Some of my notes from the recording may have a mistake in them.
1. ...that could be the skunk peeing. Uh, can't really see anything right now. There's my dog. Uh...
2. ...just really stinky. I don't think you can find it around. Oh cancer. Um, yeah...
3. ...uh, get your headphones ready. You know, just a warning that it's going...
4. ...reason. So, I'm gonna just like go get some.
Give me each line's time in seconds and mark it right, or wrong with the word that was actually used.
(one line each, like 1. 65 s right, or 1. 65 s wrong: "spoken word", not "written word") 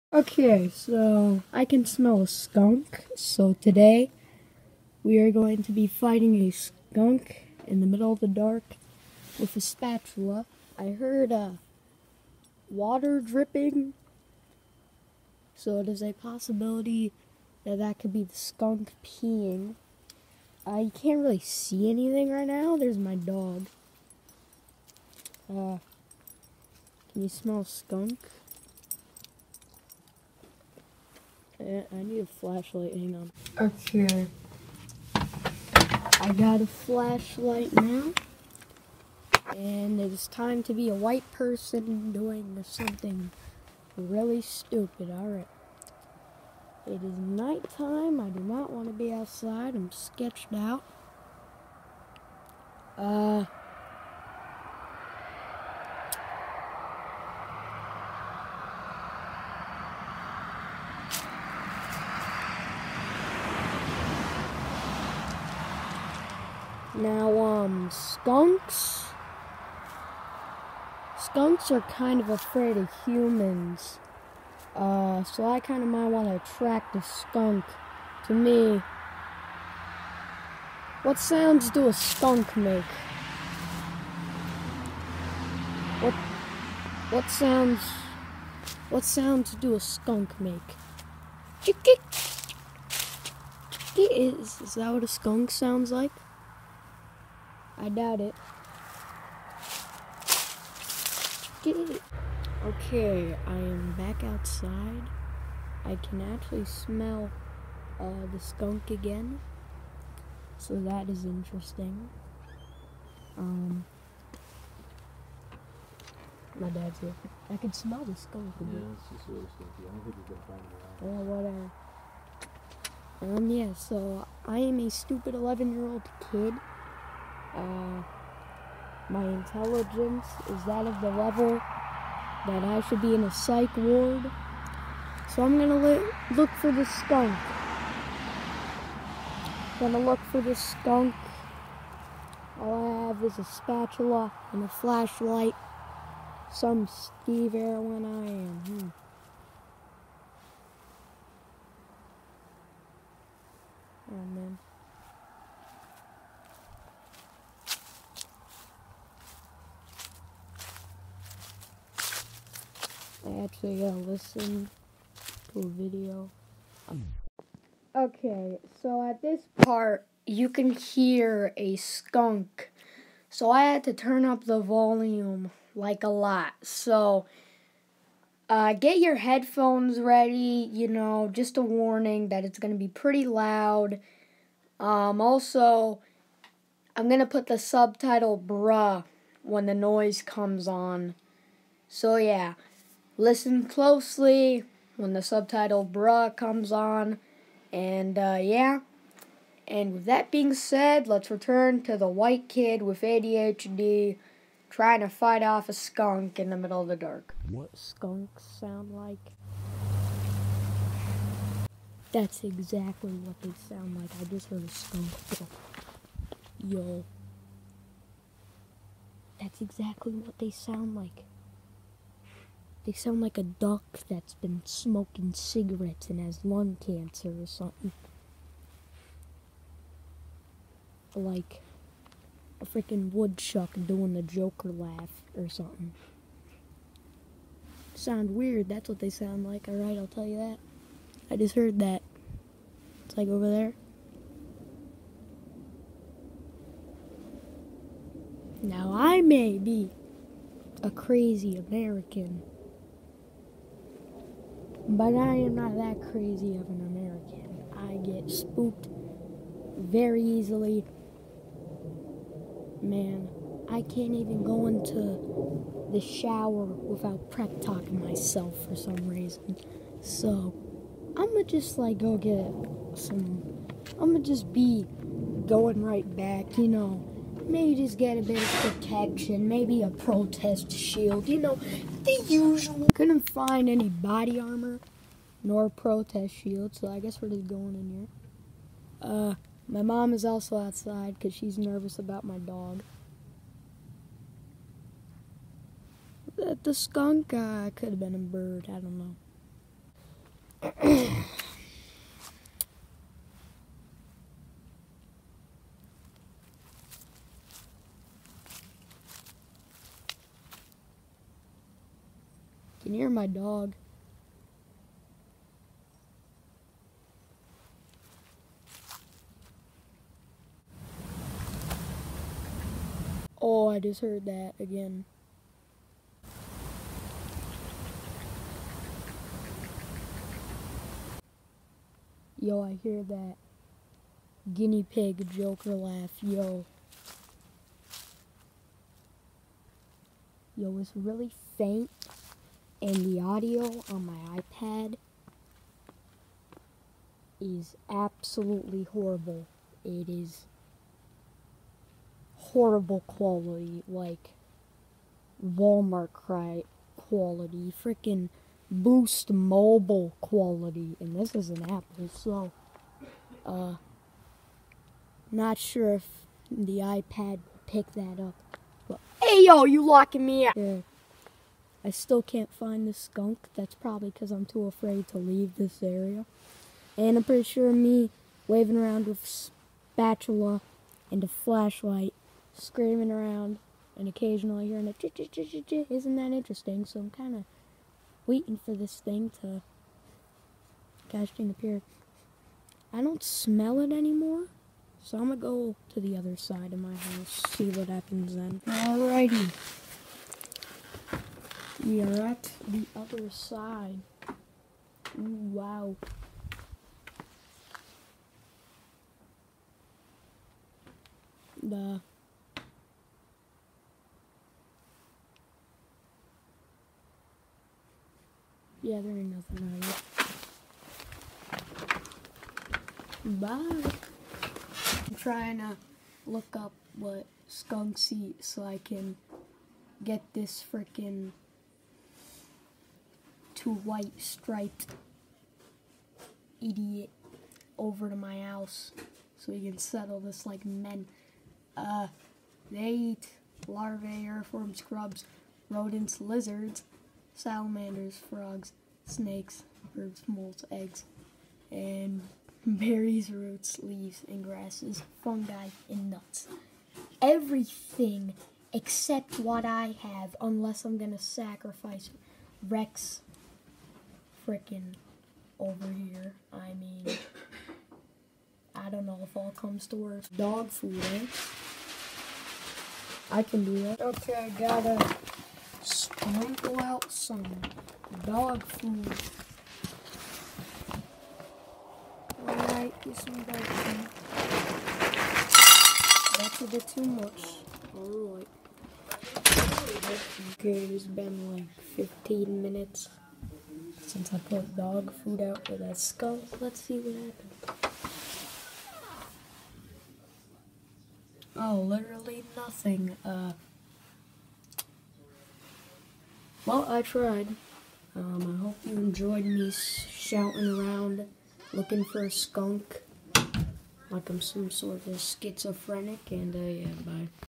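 1. 17 s right
2. 119 s wrong: "whatever", not "cancer"
3. 178 s right
4. 269 s right.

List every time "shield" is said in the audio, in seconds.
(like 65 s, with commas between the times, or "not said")
280 s, 286 s.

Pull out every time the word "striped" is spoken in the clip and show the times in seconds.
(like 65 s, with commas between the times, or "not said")
434 s.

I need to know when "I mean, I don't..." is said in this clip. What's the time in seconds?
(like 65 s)
466 s.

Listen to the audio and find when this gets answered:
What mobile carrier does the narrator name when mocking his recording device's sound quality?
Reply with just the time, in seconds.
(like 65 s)
358 s.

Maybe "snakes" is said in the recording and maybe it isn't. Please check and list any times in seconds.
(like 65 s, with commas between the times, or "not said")
449 s.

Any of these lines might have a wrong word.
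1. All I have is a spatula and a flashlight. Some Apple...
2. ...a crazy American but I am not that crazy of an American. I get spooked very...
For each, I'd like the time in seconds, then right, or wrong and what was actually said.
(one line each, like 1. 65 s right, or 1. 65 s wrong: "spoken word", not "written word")
1. 142 s wrong: "Steve", not "Apple"
2. 250 s right.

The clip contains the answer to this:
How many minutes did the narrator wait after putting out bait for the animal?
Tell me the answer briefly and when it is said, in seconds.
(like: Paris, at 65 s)
15, at 491 s.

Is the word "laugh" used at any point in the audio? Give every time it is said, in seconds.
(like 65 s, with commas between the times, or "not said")
234 s, 335 s.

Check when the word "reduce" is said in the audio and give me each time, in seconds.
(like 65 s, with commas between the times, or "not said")
not said.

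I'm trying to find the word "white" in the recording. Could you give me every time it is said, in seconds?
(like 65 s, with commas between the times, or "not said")
40 s, 202 s, 433 s.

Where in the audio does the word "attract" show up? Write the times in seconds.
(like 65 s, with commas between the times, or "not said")
76 s.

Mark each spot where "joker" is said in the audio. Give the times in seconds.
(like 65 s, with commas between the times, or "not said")
234 s, 335 s.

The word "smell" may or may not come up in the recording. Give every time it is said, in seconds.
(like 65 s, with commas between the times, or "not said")
1 s, 27 s, 106 s, 117 s, 393 s.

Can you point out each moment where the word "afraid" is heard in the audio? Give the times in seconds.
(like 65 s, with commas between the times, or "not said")
72 s, 374 s.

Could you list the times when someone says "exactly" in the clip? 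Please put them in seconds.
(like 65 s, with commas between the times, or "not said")
212 s, 219 s.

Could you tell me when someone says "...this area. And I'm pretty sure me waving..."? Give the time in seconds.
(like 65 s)
375 s.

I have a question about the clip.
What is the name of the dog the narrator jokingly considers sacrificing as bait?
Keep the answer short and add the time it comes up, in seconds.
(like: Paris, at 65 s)
Rex, at 462 s.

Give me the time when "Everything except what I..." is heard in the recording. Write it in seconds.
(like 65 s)
457 s.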